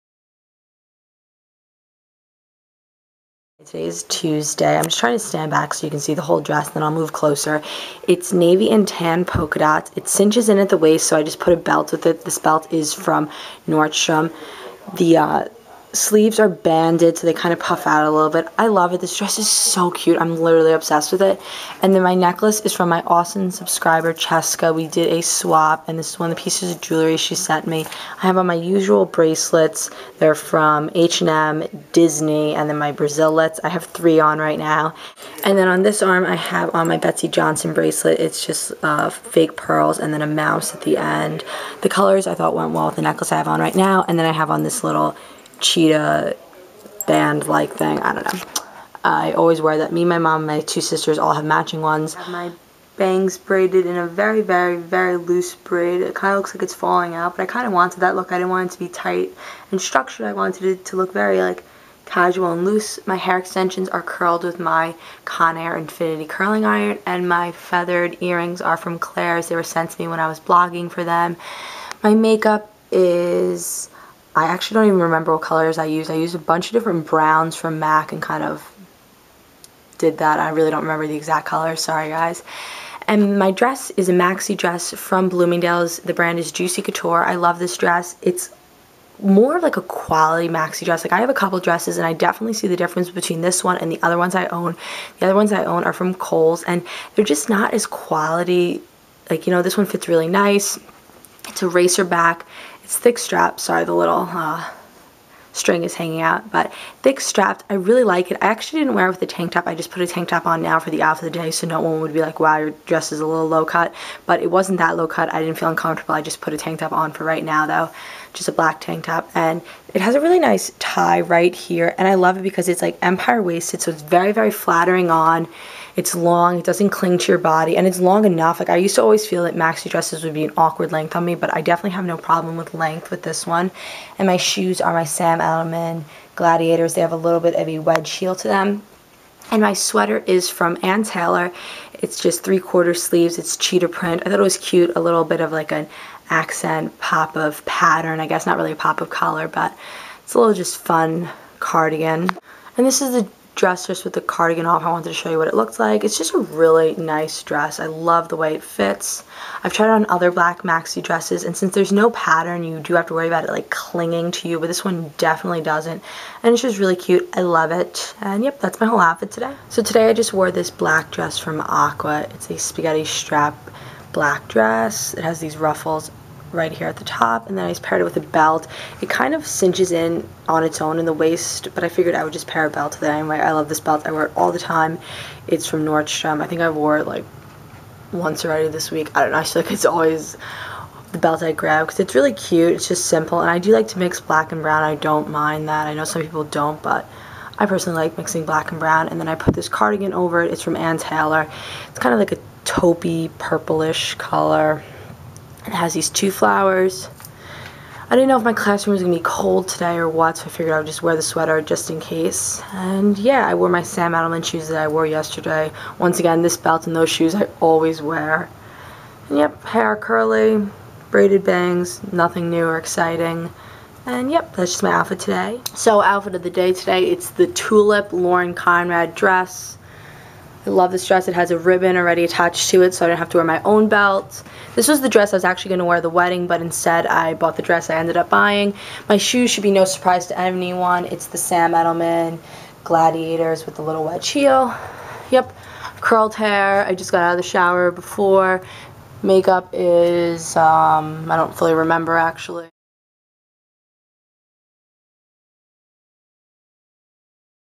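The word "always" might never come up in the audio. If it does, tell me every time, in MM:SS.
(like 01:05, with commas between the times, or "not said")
00:49, 02:09, 03:09, 03:37.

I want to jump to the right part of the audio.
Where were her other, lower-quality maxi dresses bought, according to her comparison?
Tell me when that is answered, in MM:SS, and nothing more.
01:36.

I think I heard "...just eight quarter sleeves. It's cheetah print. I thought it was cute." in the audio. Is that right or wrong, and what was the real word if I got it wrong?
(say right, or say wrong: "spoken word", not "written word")
wrong: "three", not "eight".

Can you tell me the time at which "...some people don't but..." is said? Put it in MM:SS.
03:16.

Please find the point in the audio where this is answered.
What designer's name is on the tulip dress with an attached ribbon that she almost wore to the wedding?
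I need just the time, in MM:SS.
03:48.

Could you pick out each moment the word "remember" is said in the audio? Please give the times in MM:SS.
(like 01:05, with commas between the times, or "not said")
01:15, 01:20, 04:11.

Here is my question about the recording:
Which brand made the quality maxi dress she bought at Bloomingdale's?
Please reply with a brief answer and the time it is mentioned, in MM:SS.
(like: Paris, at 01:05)
Juicy Couture, at 01:26.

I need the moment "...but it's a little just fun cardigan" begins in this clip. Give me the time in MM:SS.
02:29.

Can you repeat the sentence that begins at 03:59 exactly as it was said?
My shoes should be no surprise to anyone.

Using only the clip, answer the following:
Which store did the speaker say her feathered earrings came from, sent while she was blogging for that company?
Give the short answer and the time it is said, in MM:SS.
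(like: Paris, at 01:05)
Claire's, at 01:08.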